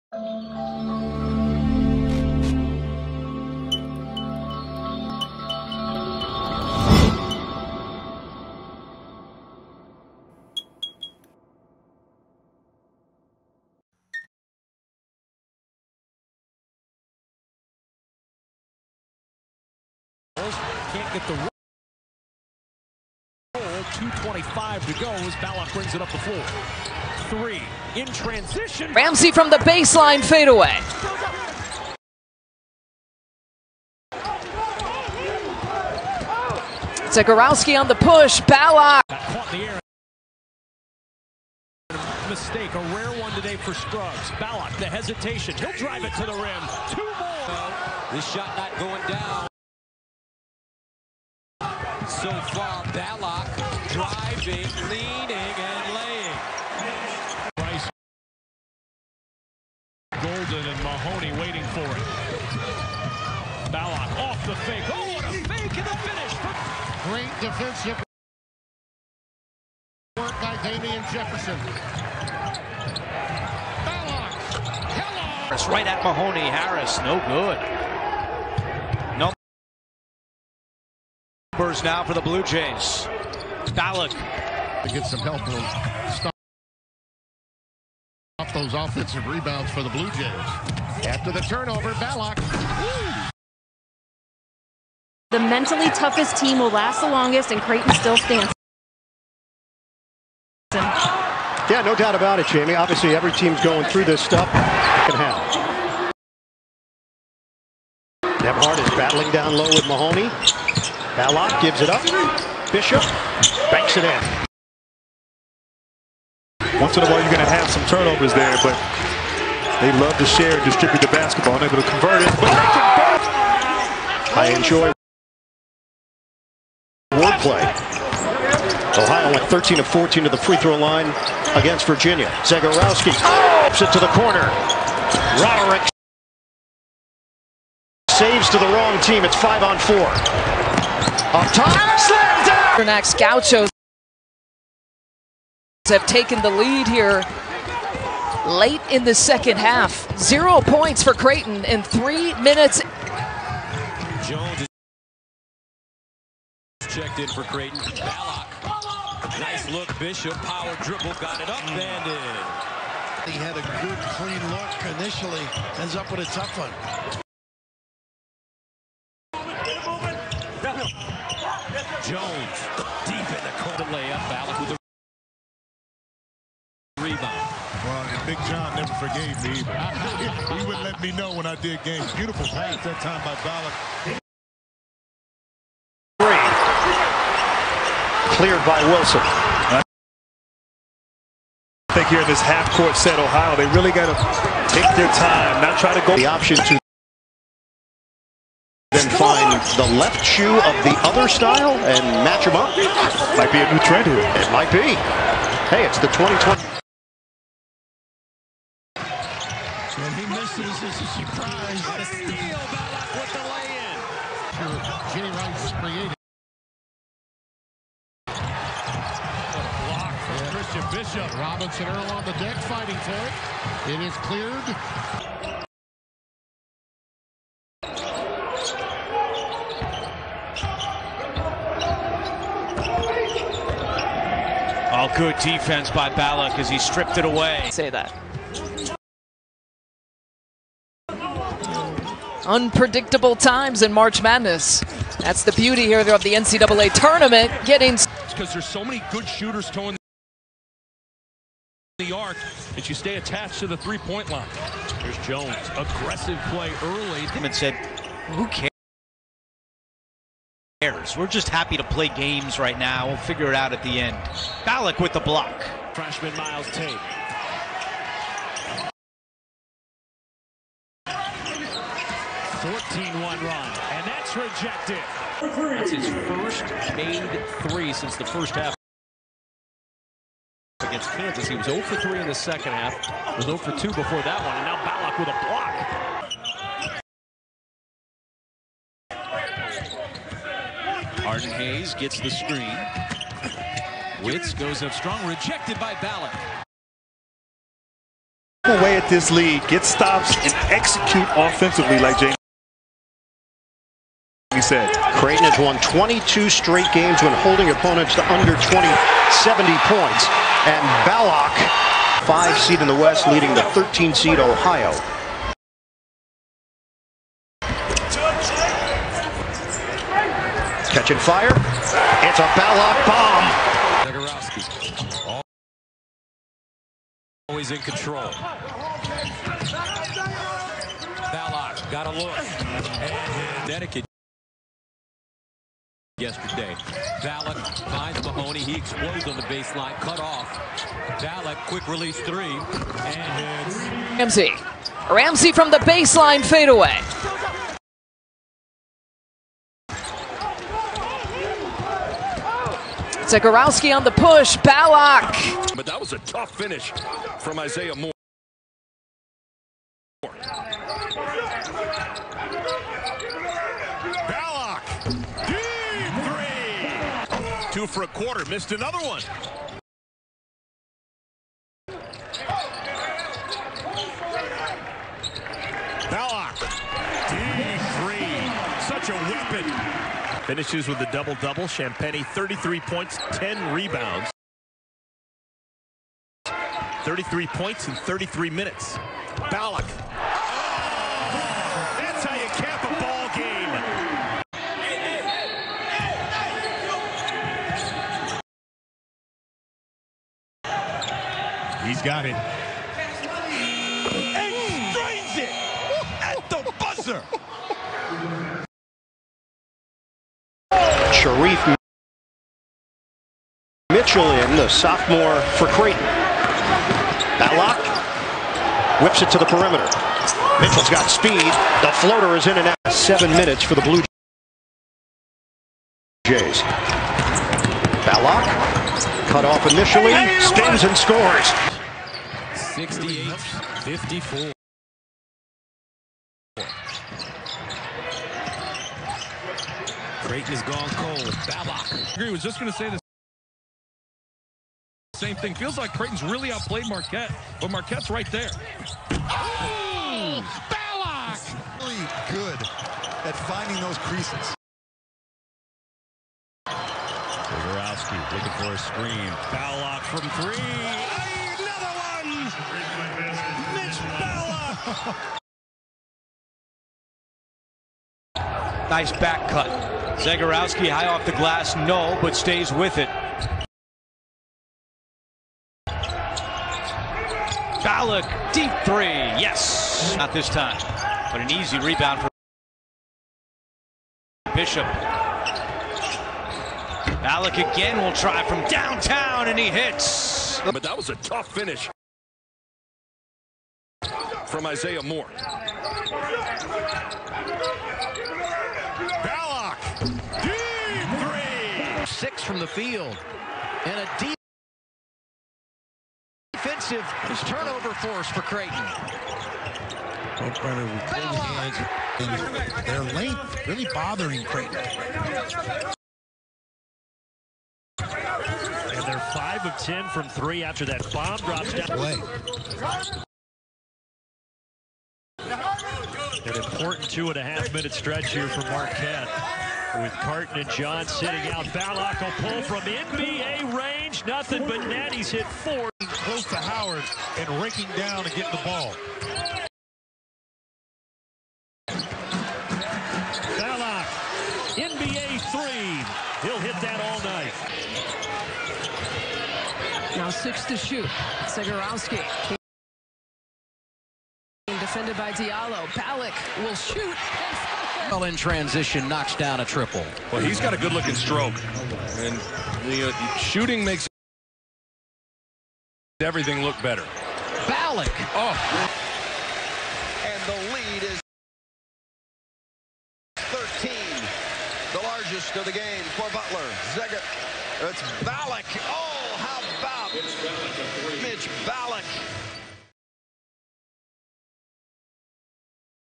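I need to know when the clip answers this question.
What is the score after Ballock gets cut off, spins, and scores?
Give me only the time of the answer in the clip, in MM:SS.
07:12.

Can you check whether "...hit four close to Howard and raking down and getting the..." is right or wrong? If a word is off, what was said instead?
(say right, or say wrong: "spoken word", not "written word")
right.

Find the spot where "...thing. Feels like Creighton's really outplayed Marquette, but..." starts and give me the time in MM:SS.
07:25.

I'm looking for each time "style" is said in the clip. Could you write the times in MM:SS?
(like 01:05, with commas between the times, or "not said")
03:21.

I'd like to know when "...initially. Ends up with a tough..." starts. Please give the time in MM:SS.
02:44.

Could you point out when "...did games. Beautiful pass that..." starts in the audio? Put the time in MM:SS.
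03:01.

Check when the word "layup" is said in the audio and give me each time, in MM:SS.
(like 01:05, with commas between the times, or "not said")
02:53.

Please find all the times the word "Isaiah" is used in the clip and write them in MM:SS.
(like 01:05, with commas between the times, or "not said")
05:57, 08:14.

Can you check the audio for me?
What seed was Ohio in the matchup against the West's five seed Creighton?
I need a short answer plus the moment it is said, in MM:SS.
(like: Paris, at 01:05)
13, at 05:13.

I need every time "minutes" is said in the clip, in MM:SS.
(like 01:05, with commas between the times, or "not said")
02:32, 06:28, 07:03, 08:47.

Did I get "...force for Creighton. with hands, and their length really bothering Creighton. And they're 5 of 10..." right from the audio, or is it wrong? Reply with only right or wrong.
right.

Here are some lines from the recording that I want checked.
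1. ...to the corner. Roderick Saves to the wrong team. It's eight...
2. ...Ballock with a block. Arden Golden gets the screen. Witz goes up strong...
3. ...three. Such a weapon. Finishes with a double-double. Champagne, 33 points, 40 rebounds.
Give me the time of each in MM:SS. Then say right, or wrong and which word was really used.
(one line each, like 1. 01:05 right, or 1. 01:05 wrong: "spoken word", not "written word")
1. 02:13 wrong: "five", not "eight"
2. 04:44 wrong: "Hayes", not "Golden"
3. 06:18 wrong: "10", not "40".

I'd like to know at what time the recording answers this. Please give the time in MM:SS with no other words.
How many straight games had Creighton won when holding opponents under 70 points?
05:05.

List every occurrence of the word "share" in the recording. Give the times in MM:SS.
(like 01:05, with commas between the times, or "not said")
02:00.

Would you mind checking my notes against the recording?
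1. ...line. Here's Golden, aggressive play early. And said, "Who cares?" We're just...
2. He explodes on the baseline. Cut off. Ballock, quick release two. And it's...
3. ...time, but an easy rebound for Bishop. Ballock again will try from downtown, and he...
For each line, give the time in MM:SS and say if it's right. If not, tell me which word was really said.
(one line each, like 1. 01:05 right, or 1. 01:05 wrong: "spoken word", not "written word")
1. 04:14 wrong: "Jones", not "Golden"
2. 05:38 wrong: "three", not "two"
3. 08:00 right.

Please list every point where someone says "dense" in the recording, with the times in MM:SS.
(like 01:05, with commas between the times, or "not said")
not said.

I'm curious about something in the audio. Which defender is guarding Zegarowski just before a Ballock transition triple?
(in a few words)
Diallo.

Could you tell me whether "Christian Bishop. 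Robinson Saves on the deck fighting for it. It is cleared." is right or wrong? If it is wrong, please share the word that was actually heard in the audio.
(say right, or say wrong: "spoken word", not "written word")
wrong: "Earl", not "Saves".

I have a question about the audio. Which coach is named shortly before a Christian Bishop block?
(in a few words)
Jay Wright.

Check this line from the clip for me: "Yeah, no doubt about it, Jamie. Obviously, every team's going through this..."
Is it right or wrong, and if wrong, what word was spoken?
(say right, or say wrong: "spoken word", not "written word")
right.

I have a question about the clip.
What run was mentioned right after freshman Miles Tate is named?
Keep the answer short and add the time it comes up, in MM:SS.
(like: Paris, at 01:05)
14-1, at 04:32.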